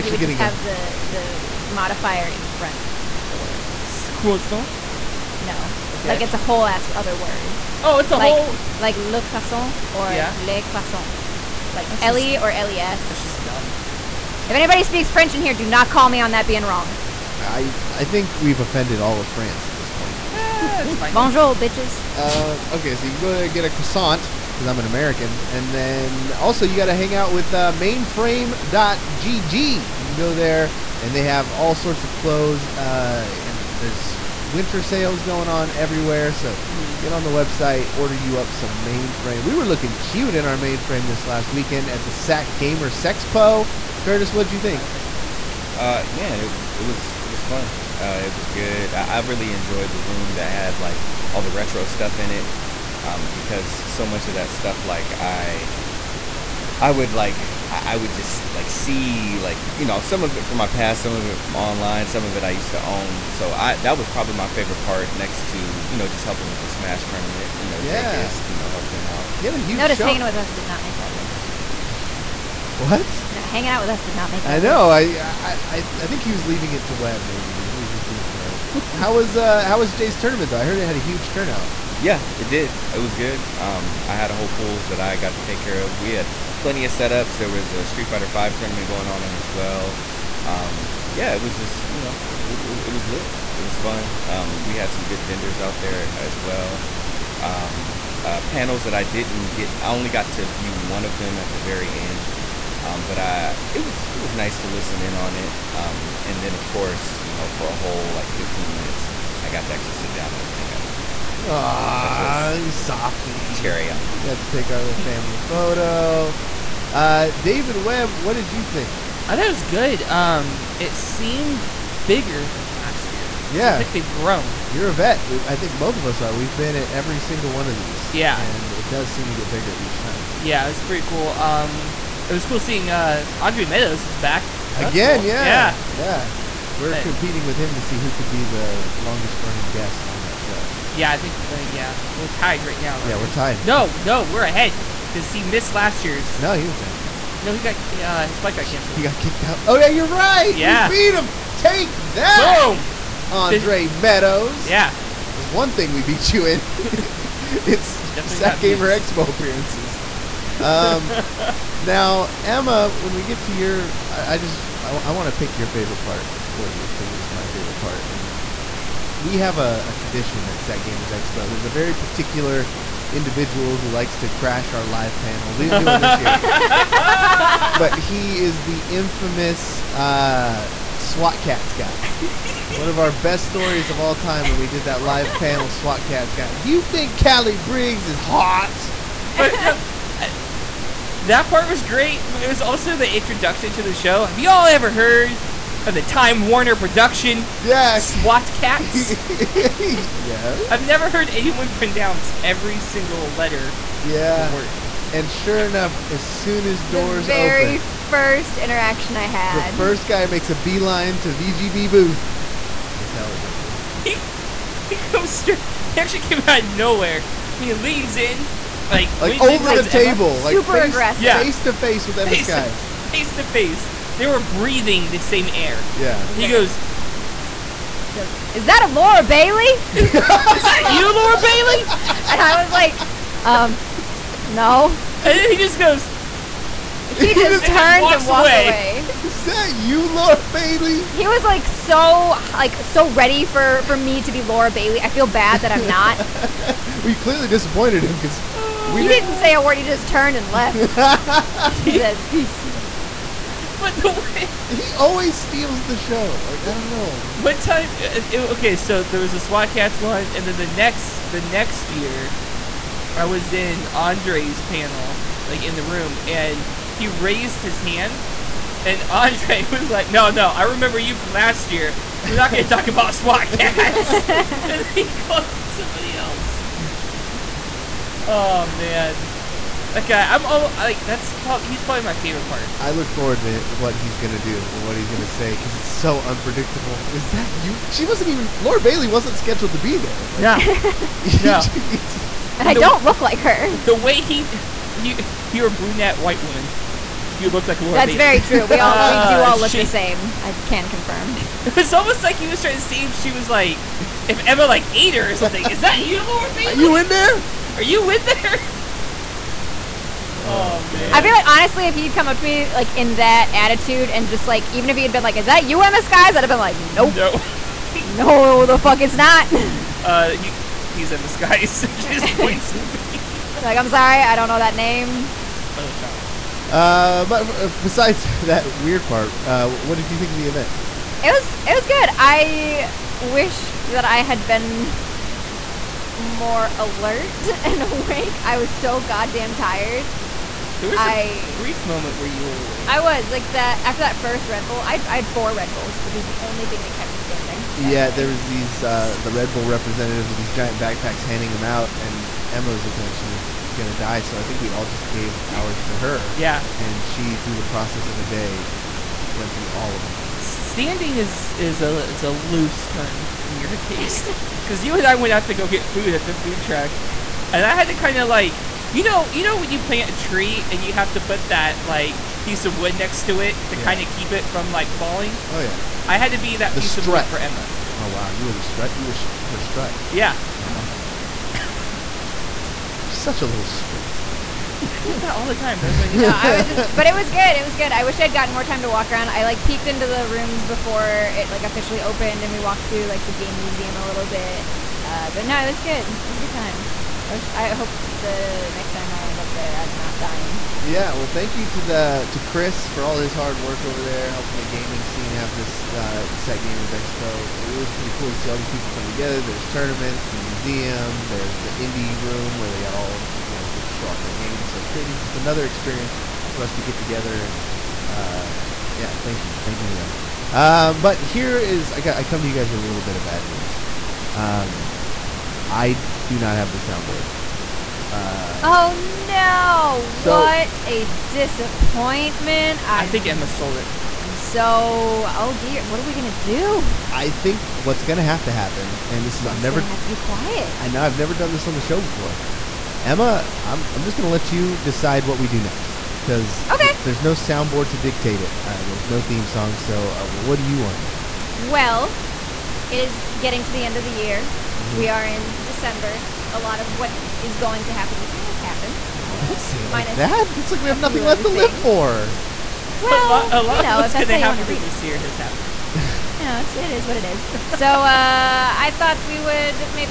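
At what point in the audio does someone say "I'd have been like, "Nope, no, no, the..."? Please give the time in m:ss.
5:16.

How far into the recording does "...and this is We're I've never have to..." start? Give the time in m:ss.
7:19.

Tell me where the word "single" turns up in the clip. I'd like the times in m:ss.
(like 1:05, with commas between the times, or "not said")
2:07, 3:22.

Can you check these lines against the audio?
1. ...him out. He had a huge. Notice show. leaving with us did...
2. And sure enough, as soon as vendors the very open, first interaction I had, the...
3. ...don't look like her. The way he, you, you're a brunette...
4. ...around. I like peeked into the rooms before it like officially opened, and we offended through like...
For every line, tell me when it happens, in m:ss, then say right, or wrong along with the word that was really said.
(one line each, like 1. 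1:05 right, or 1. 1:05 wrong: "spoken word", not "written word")
1. 1:08 wrong: "hanging", not "leaving"
2. 3:25 wrong: "doors", not "vendors"
3. 4:52 right
4. 6:29 wrong: "walked", not "offended".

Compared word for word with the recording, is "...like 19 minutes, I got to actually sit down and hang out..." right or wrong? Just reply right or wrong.
wrong.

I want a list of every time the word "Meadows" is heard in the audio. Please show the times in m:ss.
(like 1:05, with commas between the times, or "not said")
2:13, 2:33.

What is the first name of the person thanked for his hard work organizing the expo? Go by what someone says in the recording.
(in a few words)
Chris.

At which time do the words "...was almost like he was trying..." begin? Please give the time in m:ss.
5:01.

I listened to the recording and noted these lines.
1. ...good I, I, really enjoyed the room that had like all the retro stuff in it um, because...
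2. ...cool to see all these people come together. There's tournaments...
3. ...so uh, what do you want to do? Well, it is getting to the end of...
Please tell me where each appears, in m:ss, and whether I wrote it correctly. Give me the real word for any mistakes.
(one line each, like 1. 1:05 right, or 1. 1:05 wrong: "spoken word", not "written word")
1. 0:48 right
2. 6:48 right
3. 7:29 right.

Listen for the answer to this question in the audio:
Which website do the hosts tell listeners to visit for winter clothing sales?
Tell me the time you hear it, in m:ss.
0:27.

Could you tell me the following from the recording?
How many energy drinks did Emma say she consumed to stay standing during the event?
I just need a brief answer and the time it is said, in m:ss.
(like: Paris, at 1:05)
4, at 5:45.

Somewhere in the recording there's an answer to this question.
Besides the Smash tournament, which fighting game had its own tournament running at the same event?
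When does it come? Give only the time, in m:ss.
1:27.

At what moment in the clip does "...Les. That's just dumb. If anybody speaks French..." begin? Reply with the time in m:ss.
0:12.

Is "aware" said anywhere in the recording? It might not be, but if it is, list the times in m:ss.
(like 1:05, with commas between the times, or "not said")
not said.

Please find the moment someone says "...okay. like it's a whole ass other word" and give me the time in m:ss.
0:05.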